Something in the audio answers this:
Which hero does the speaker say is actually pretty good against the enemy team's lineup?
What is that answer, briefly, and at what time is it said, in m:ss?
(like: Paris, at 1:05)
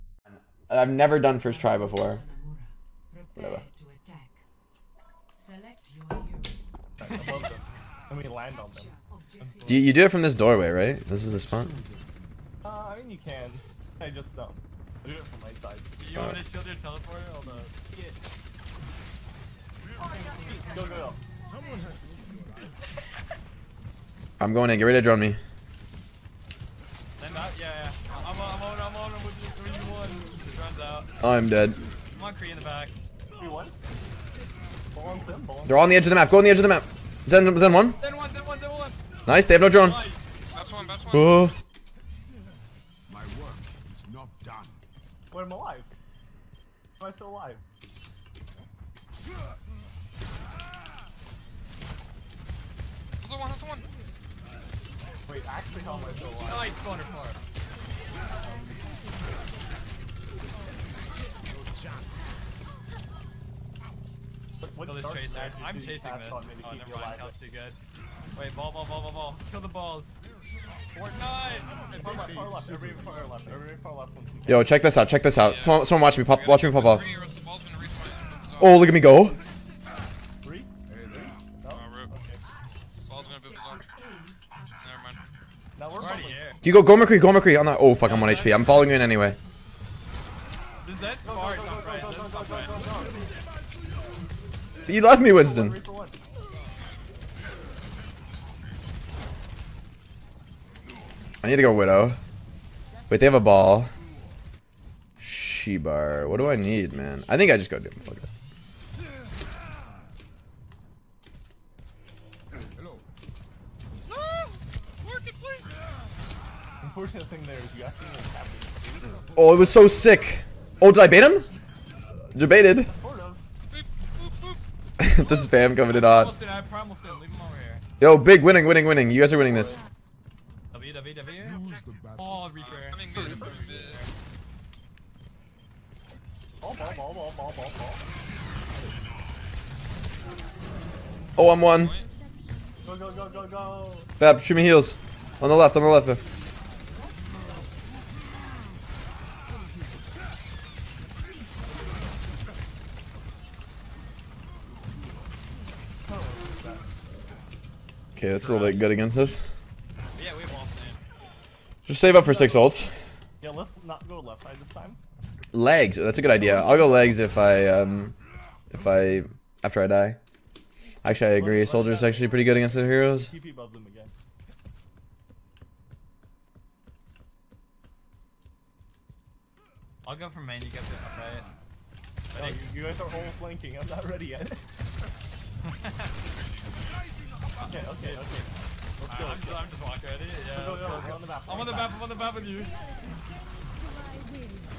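Soldier, at 2:51.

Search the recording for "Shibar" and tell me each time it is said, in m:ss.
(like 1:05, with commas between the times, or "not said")
1:45.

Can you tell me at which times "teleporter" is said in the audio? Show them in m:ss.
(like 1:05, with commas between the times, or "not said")
0:16.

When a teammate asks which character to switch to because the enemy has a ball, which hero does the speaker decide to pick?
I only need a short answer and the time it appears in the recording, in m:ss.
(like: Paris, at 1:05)
Doom, at 1:47.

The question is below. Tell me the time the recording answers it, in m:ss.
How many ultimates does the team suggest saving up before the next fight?
2:42.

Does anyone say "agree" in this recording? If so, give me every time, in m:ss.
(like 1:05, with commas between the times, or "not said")
2:51.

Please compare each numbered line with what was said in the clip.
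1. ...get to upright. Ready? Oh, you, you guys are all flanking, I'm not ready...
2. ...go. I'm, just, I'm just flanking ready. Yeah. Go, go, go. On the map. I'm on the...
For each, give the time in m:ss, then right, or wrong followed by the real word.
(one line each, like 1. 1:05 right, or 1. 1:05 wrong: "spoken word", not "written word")
1. 3:00 right
2. 3:09 wrong: "walking", not "flanking".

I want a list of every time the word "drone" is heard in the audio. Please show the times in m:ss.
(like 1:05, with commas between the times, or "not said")
0:25, 0:39.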